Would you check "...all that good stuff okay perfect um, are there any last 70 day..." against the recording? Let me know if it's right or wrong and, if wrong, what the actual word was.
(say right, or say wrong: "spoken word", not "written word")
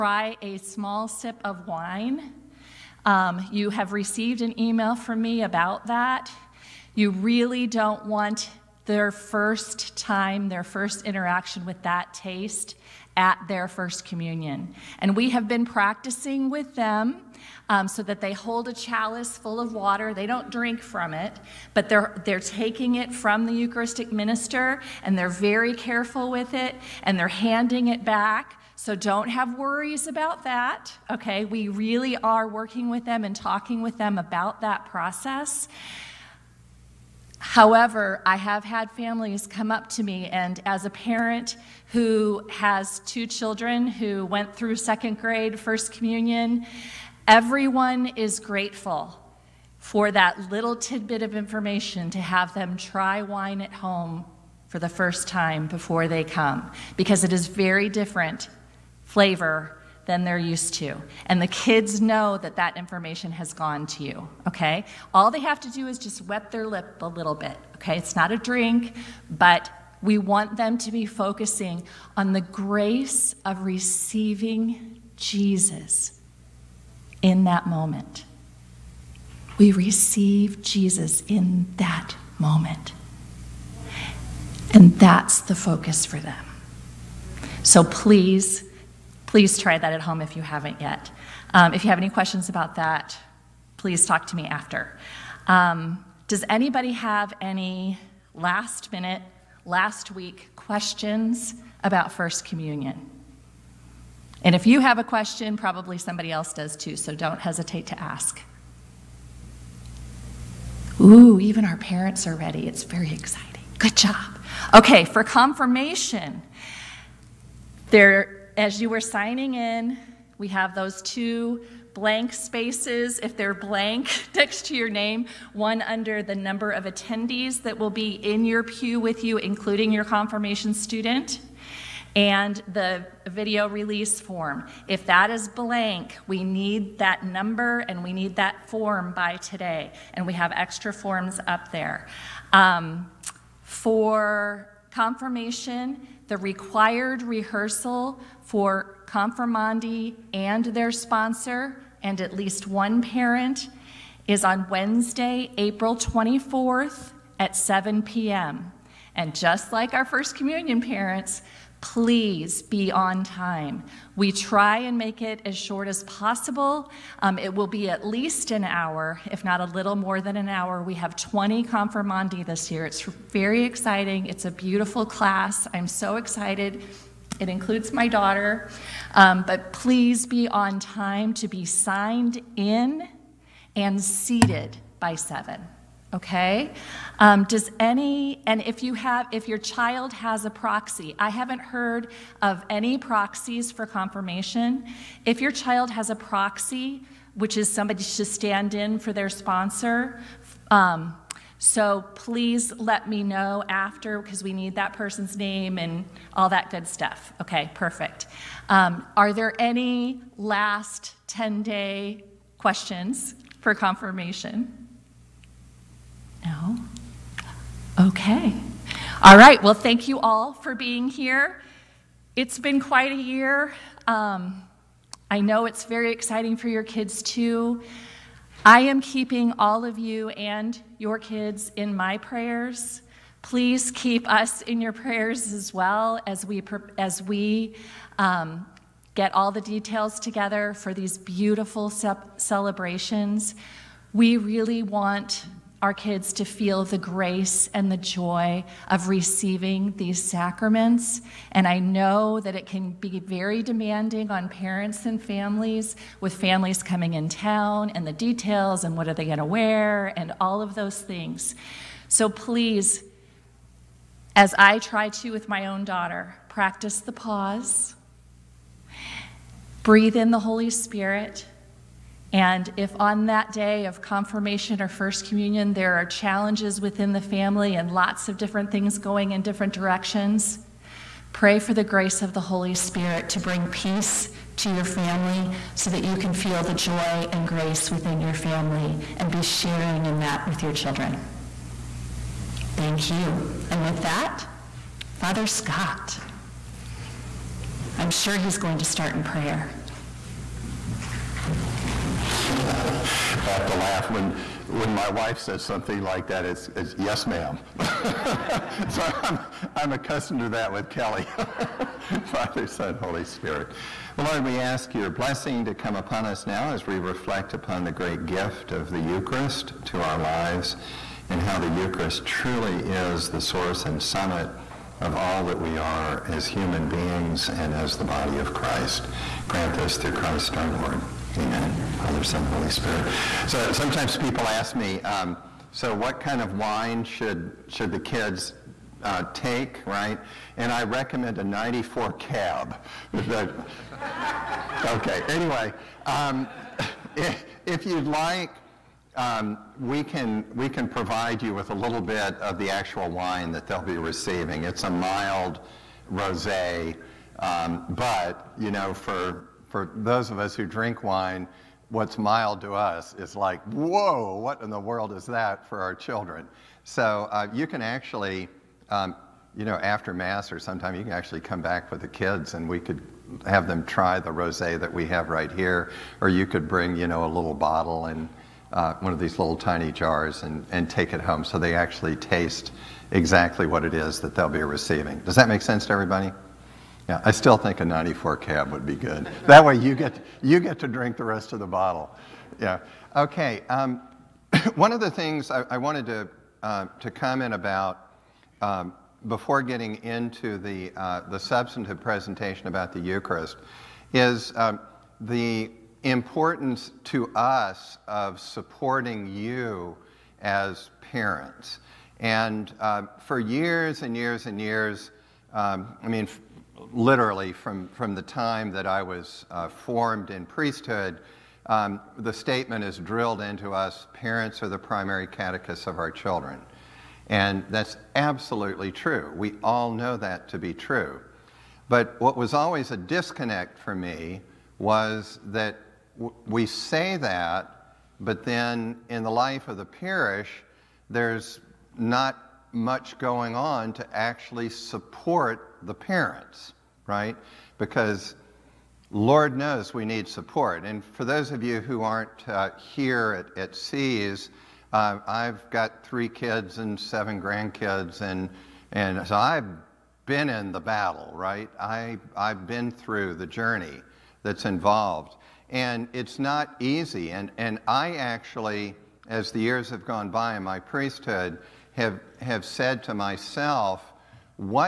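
wrong: "10", not "70".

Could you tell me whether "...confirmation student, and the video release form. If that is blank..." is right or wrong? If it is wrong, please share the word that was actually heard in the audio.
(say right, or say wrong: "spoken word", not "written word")
right.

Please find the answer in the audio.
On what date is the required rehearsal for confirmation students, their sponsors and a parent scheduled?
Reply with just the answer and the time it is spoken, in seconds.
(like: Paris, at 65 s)
Wednesday, April 24th, at 154 s.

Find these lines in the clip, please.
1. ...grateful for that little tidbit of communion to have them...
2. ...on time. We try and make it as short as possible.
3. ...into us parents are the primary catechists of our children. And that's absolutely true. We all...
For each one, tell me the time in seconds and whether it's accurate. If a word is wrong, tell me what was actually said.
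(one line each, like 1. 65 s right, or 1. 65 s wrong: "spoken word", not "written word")
1. 48 s wrong: "information", not "communion"
2. 162 s right
3. 423 s right.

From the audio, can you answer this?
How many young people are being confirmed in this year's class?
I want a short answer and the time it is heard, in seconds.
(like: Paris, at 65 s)
20, at 171 s.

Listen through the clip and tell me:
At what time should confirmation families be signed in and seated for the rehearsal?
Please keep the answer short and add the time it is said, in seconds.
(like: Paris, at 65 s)
7, at 184 s.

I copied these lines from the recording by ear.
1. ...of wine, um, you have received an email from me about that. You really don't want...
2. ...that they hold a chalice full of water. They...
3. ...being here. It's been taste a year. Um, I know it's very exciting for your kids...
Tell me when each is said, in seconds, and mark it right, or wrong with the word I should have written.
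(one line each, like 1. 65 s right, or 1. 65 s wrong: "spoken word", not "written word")
1. 1 s right
2. 18 s right
3. 220 s wrong: "quite", not "taste".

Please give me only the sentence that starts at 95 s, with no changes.
Um, does anybody have any last minute, last week questions about First Communion?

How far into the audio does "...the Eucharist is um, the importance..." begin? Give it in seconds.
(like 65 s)
402 s.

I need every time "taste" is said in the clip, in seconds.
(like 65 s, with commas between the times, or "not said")
12 s, 382 s.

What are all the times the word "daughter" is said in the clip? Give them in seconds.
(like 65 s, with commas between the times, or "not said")
178 s, 265 s.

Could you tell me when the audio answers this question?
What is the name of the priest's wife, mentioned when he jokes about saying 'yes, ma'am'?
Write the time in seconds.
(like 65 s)
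310 s.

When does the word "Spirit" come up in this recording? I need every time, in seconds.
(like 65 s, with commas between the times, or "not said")
270 s, 282 s, 313 s, 332 s.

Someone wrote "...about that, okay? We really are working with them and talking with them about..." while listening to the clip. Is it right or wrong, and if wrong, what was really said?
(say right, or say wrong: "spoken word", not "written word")
right.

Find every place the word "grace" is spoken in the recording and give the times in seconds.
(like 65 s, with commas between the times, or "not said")
72 s, 246 s, 281 s, 287 s.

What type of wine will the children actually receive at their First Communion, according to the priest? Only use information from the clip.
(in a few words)
mild rosé.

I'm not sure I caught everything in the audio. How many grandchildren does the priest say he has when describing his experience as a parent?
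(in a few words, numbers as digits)
7.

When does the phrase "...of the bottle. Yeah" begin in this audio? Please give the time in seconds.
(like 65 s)
391 s.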